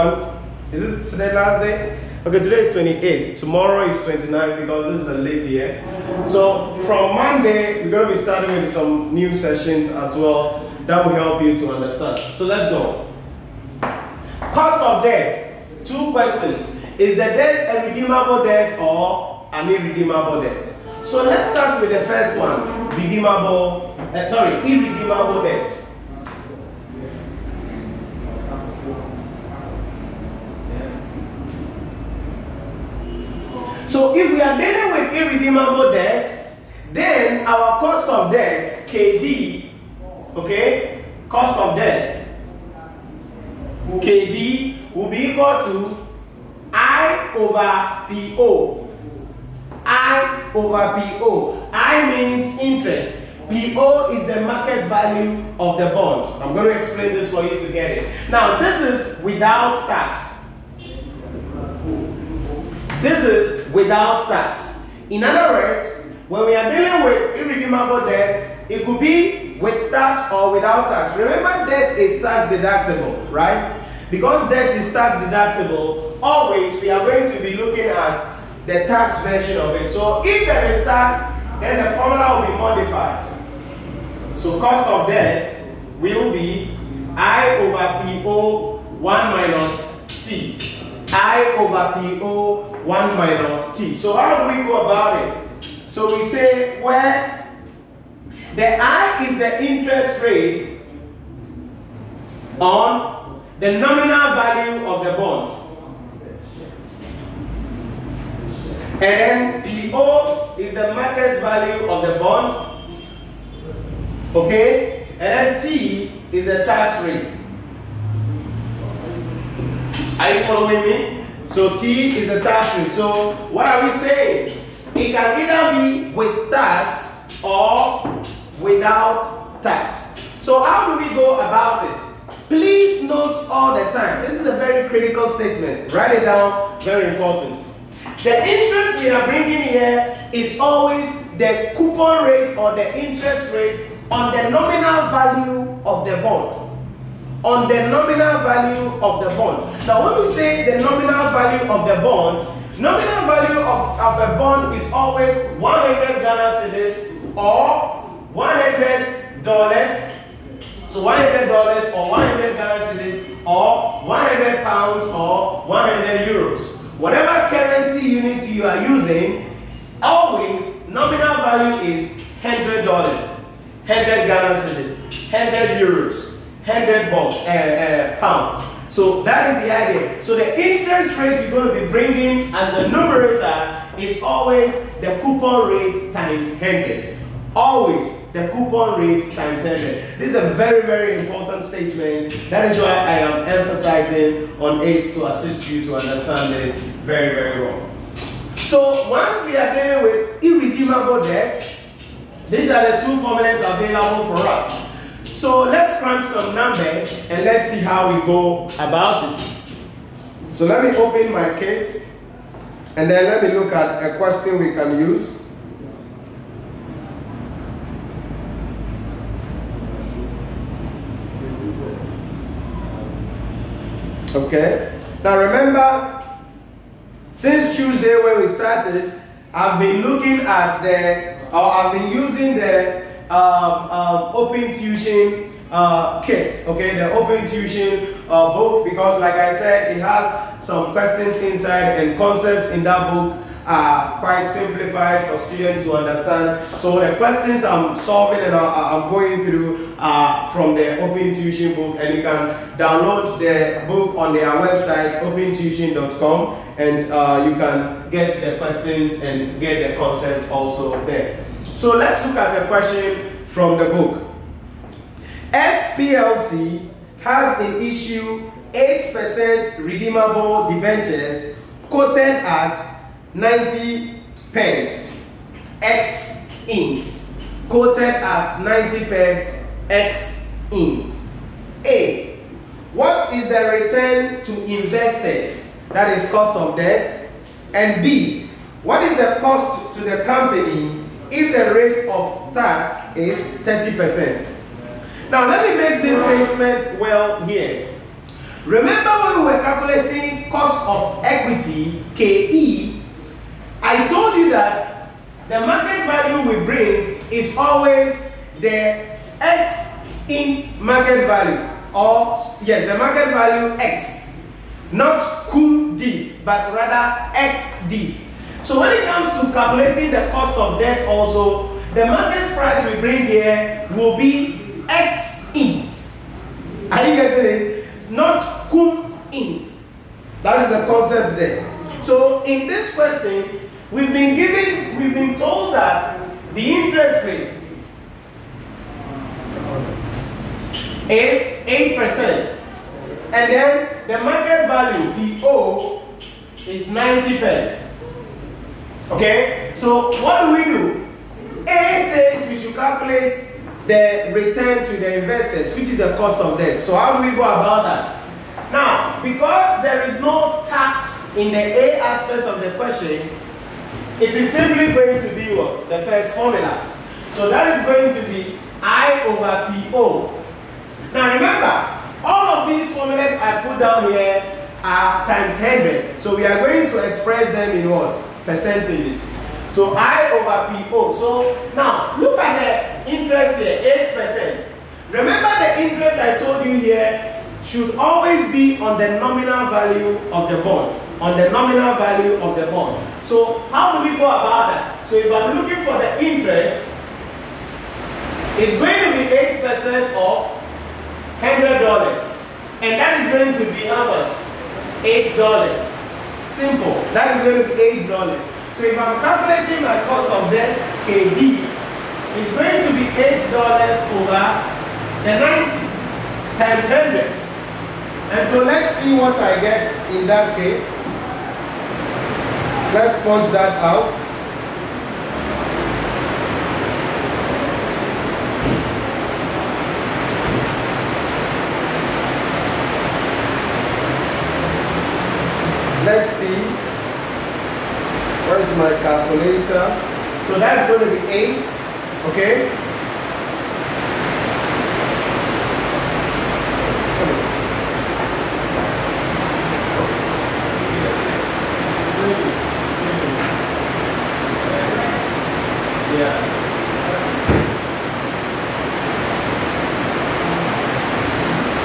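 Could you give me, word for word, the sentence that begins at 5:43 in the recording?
And then the market value, PO, is 90 pence.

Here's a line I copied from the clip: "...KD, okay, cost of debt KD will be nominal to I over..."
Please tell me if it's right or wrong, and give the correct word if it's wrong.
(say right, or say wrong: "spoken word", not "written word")
wrong: "equal", not "nominal".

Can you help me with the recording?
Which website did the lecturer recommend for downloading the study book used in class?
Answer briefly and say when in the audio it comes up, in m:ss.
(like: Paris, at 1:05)
opentuition.com, at 4:15.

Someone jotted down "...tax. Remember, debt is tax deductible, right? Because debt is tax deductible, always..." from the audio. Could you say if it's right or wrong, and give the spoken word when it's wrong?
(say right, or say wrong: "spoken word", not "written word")
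right.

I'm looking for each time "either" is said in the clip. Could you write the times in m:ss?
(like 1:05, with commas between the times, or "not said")
2:05.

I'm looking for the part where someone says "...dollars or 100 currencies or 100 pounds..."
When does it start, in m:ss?
2:41.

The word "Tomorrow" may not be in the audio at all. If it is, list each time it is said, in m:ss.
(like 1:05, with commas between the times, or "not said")
0:03.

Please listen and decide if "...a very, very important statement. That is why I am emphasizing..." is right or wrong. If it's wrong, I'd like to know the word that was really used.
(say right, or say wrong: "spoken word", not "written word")
right.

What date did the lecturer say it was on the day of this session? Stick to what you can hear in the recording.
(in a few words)
28th.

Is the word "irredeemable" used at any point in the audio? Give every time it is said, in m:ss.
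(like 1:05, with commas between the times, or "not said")
0:19, 0:24, 0:35, 1:07, 3:20.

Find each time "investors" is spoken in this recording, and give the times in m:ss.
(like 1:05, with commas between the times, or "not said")
4:44, 5:55.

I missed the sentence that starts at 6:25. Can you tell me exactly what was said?
Remember the interest I told you here should always be on the nominal value of the bond.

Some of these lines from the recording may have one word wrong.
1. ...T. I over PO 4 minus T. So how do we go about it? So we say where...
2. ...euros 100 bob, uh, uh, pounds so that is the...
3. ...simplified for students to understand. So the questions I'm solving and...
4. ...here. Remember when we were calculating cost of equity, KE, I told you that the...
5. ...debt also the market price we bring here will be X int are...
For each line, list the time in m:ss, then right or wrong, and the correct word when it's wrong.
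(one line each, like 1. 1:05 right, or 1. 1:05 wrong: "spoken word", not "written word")
1. 1:30 wrong: "1", not "4"
2. 2:55 right
3. 4:04 right
4. 4:57 right
5. 5:20 right.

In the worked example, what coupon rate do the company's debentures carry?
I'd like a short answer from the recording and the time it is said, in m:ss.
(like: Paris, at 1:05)
8%, at 4:28.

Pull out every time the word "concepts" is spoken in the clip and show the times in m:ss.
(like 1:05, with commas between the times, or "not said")
4:02, 4:19, 5:30.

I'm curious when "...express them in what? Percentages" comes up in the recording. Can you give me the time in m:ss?
6:17.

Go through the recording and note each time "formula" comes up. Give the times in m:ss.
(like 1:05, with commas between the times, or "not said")
1:21, 3:23, 6:06, 6:12.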